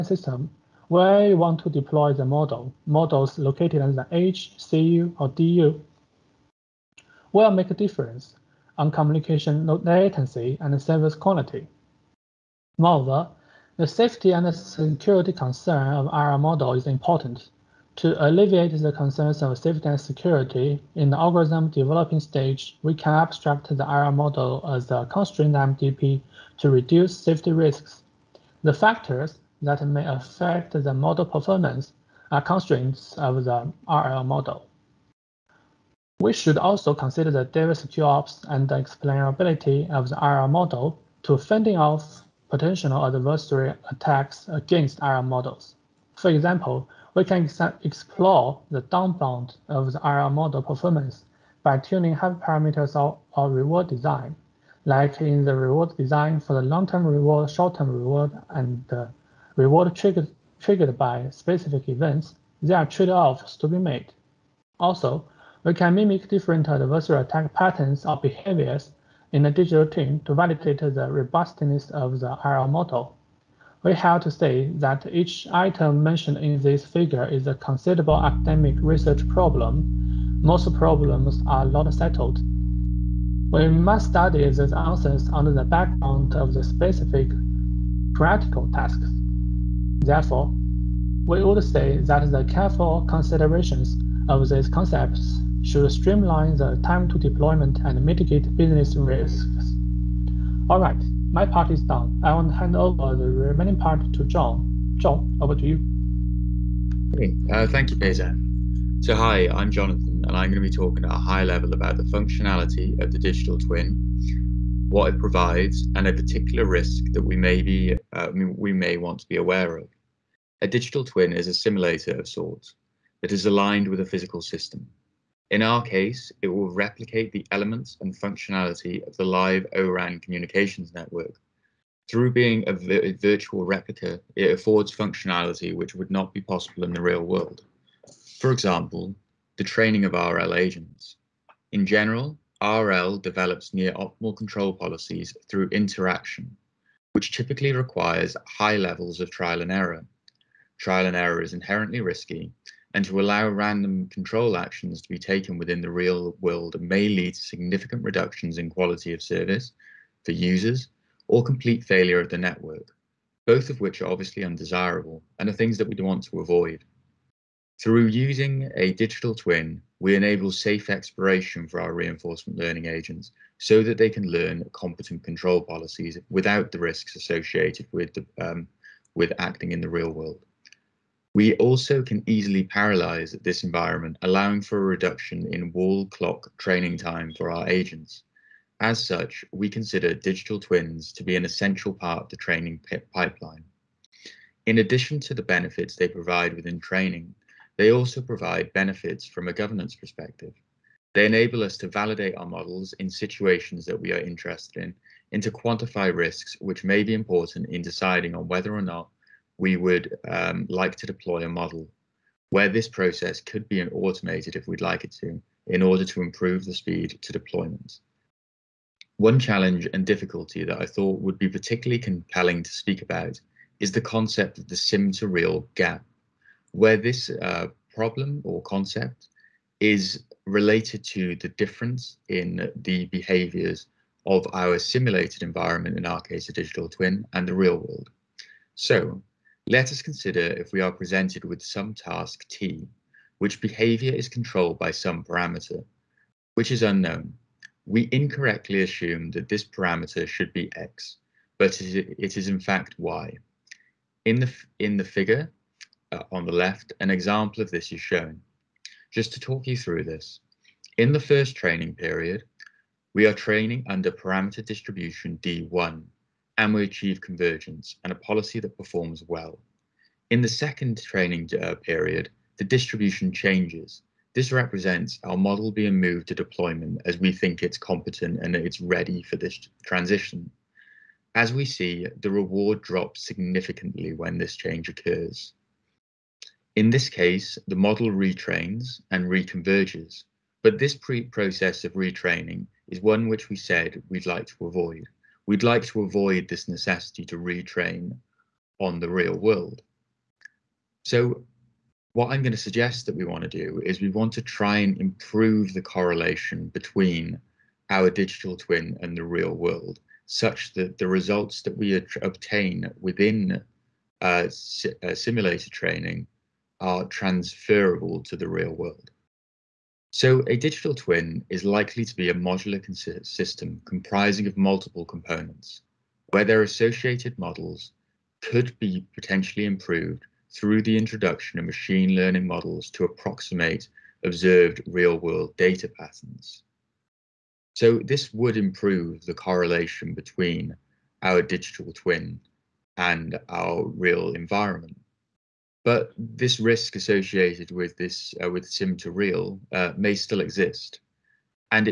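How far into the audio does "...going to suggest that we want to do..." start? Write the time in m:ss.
5:02.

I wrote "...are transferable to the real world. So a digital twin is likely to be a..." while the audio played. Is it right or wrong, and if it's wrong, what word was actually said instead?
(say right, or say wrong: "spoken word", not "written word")
right.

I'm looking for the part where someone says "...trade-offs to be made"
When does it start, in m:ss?
1:02.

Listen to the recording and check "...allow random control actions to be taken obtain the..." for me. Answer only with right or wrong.
wrong.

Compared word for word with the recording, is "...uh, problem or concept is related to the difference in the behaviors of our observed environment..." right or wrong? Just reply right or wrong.
wrong.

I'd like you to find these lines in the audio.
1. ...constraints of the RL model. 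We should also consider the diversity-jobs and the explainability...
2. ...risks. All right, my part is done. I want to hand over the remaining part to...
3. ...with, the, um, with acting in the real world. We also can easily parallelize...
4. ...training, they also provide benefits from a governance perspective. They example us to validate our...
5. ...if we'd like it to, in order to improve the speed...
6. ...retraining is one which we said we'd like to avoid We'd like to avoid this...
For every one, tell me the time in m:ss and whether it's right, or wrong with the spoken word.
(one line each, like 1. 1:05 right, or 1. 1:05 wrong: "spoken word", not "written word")
1. 0:32 right
2. 1:38 right
3. 2:57 right
4. 3:16 wrong: "enable", not "example"
5. 3:34 right
6. 4:51 right.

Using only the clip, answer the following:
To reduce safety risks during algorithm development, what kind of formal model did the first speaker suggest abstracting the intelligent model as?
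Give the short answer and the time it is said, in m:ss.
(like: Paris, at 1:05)
constrained MDP, at 0:25.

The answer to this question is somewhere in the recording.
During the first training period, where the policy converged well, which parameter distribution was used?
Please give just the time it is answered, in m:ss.
4:25.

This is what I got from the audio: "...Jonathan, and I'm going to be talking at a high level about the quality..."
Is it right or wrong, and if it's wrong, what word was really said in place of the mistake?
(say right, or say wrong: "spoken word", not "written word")
wrong: "functionality", not "quality".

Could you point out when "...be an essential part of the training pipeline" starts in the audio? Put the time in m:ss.
3:11.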